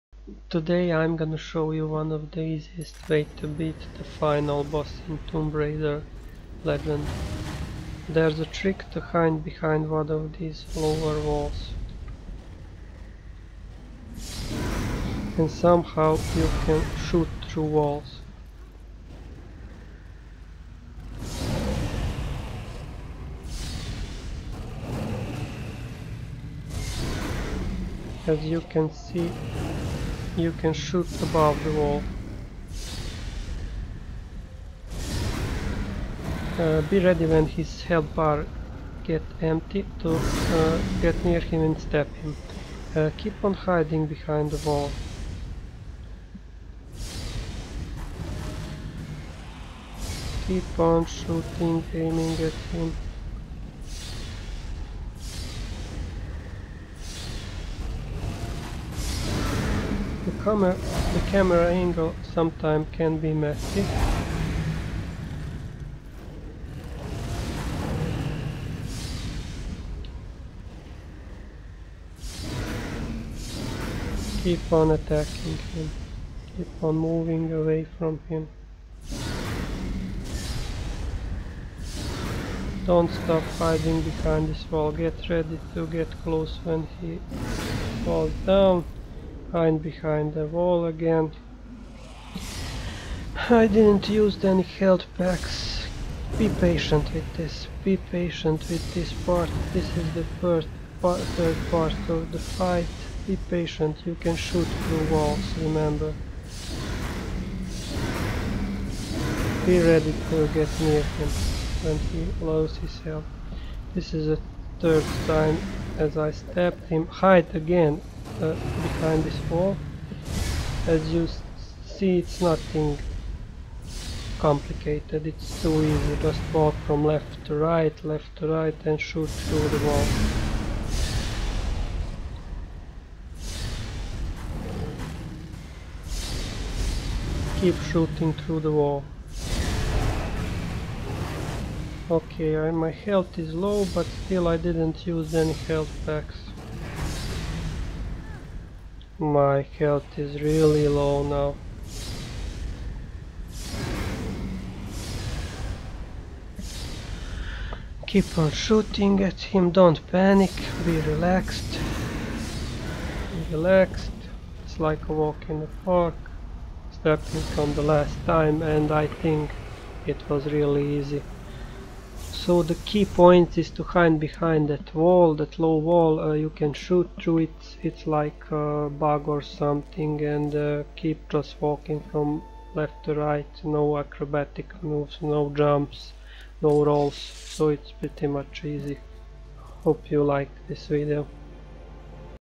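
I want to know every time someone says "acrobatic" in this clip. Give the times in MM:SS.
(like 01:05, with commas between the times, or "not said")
03:03.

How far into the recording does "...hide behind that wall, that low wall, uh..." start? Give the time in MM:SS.
02:53.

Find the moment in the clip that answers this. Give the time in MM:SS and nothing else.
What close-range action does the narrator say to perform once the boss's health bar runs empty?
00:41.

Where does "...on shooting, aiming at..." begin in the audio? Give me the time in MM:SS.
00:50.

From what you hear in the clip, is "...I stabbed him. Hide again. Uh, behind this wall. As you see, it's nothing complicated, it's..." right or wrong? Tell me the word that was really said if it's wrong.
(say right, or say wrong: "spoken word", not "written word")
right.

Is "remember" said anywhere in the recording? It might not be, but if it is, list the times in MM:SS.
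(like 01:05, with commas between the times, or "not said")
01:45.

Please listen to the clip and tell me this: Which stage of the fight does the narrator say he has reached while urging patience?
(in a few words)
third part.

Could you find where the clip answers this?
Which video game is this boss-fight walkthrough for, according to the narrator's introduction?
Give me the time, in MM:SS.
00:05.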